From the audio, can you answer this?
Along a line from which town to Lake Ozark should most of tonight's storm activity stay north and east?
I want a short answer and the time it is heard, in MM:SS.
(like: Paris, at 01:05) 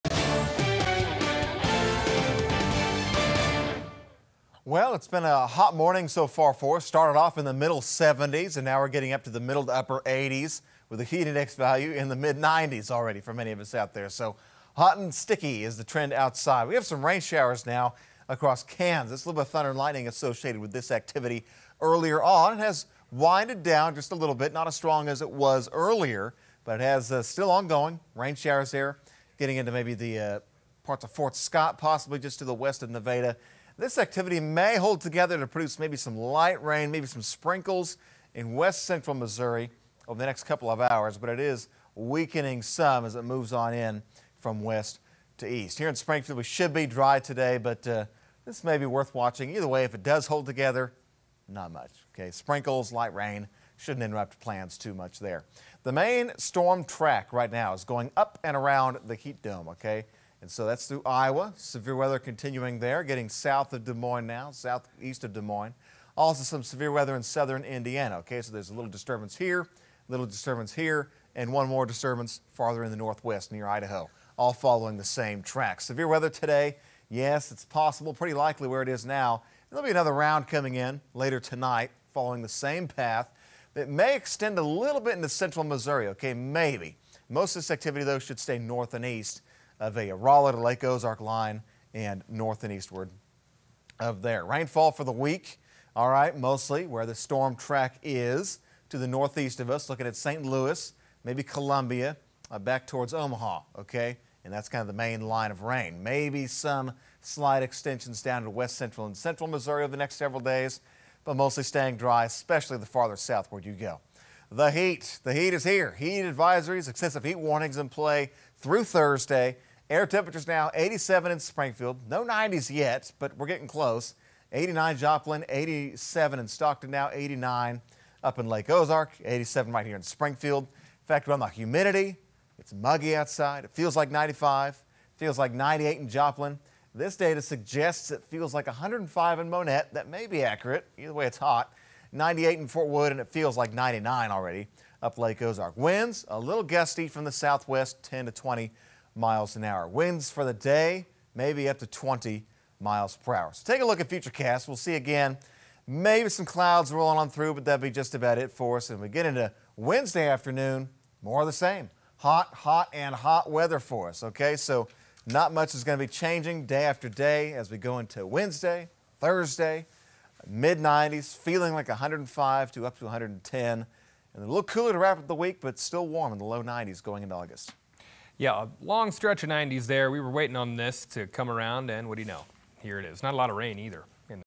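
Rolla, at 01:30.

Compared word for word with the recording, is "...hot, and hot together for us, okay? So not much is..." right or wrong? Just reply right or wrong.
wrong.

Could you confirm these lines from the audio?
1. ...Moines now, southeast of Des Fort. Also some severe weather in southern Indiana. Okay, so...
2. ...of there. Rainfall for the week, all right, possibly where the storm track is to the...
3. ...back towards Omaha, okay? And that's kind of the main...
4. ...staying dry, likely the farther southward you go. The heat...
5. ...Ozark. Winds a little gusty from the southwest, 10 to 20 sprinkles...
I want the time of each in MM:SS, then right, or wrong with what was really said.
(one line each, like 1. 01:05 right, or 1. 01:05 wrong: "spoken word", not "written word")
1. 01:03 wrong: "Moines", not "Fort"
2. 01:33 wrong: "mostly", not "possibly"
3. 01:42 right
4. 01:51 wrong: "especially", not "likely"
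5. 02:25 wrong: "miles", not "sprinkles".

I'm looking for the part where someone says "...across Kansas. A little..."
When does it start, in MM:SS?
00:18.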